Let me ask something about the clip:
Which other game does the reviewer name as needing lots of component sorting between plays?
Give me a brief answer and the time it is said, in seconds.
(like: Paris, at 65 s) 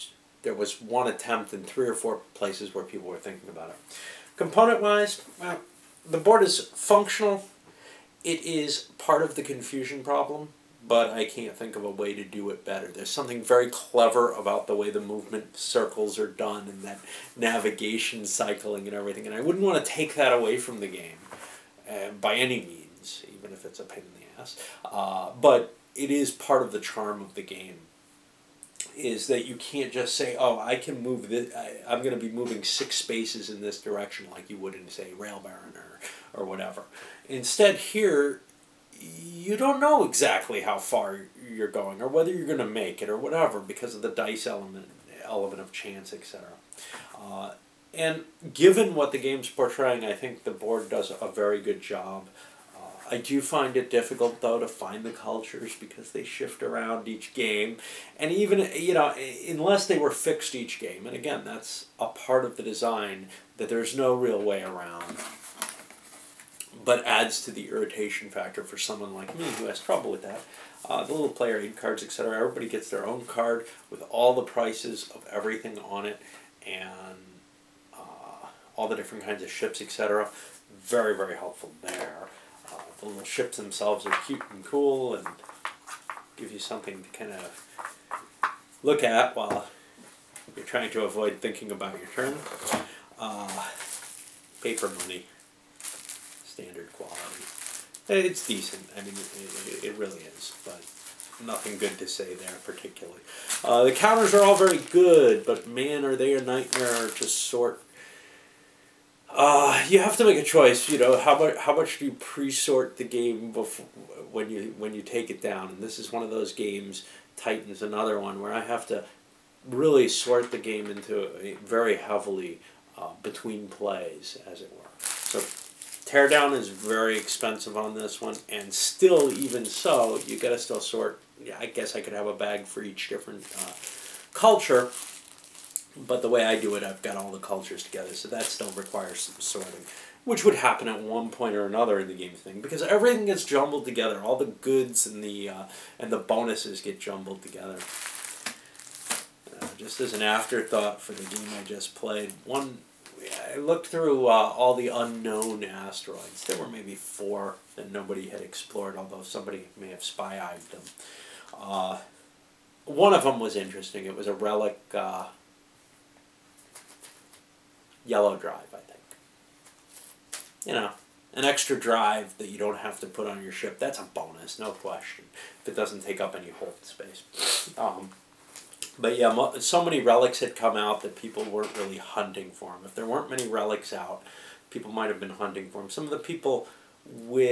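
Titan, at 117 s.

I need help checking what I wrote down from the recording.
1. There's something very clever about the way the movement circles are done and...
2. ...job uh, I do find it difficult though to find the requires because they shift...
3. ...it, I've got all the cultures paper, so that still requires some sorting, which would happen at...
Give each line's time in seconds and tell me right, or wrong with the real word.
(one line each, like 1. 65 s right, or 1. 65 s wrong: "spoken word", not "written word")
1. 12 s right
2. 51 s wrong: "cultures", not "requires"
3. 136 s wrong: "together", not "paper".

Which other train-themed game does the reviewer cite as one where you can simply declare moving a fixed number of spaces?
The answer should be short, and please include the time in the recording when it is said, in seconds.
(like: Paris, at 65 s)
Rail Baron, at 35 s.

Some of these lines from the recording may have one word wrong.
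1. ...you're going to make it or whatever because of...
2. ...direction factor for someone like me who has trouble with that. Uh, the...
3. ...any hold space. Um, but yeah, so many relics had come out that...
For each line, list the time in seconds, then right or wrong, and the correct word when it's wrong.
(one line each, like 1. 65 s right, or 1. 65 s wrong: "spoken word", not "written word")
1. 42 s right
2. 67 s wrong: "irritation", not "direction"
3. 176 s right.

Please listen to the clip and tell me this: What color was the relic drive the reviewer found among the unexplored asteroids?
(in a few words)
yellow.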